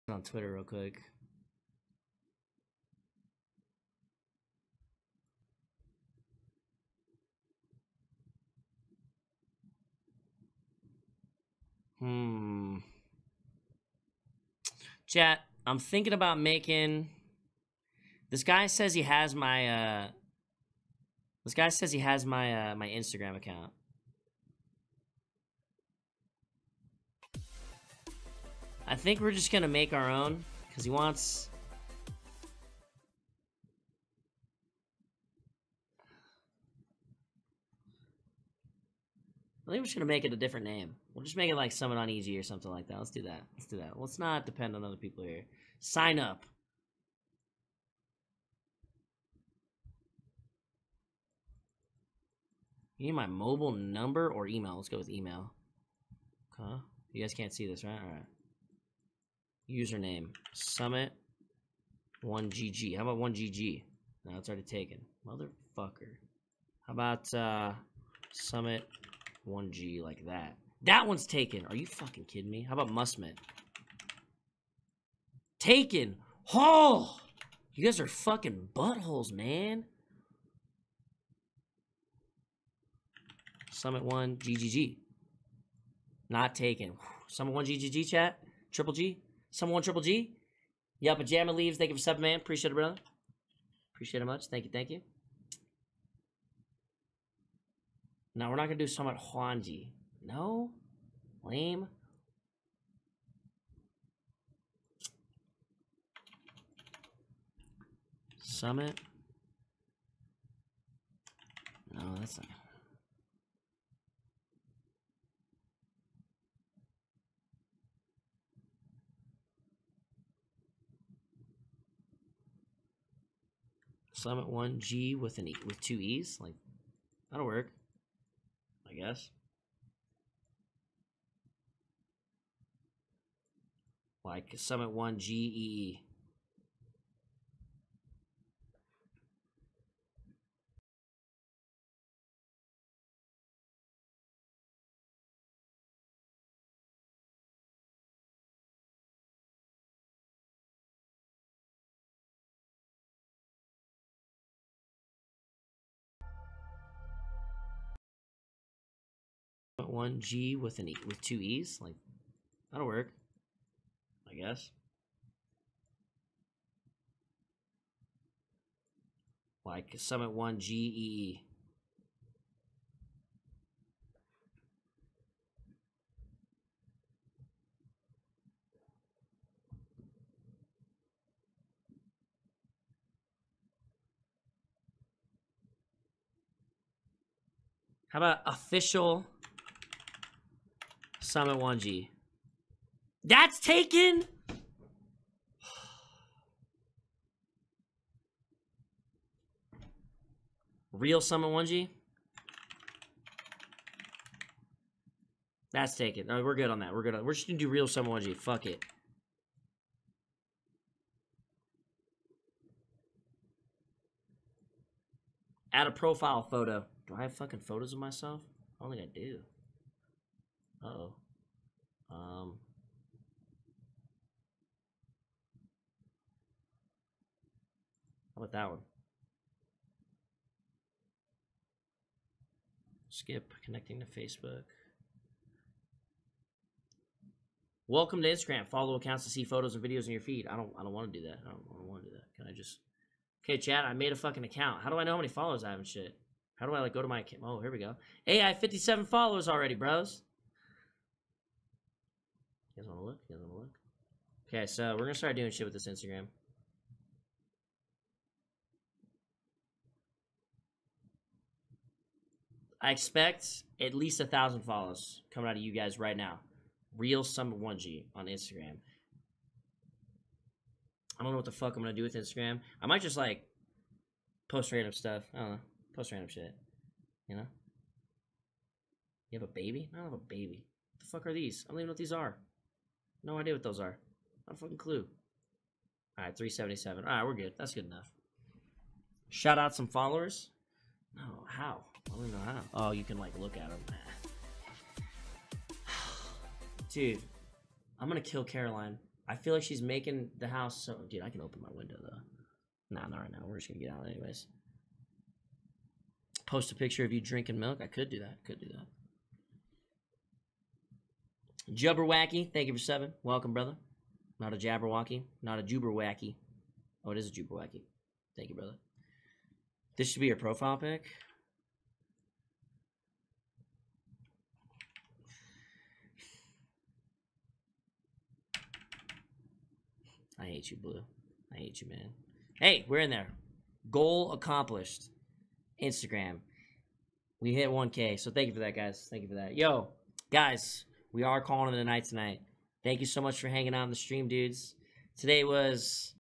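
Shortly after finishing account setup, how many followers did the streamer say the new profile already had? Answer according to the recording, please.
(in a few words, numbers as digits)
57.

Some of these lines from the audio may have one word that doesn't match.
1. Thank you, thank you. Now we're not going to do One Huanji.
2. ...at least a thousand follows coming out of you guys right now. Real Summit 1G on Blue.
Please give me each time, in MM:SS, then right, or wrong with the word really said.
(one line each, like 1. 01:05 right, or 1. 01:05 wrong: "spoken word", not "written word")
1. 01:34 wrong: "Summit", not "One"
2. 04:23 wrong: "Instagram", not "Blue".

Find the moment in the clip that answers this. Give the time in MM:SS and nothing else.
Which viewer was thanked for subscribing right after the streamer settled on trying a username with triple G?
01:31.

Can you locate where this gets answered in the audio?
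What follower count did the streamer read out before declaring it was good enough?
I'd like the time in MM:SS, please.
04:46.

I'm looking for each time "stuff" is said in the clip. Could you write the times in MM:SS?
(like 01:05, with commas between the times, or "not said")
04:34.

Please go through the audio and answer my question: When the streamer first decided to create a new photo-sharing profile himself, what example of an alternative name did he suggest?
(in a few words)
Summon on Easy.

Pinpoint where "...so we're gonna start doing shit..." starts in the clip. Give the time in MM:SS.
04:14.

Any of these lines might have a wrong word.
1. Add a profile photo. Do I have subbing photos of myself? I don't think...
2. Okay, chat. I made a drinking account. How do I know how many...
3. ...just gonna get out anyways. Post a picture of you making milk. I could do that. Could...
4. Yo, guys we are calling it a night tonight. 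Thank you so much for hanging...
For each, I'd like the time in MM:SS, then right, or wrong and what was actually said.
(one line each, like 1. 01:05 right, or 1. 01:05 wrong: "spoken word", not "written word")
1. 03:35 wrong: "fucking", not "subbing"
2. 04:03 wrong: "fucking", not "drinking"
3. 05:03 wrong: "drinking", not "making"
4. 05:39 right.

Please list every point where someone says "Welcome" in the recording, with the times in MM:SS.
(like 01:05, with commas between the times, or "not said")
03:57, 05:13.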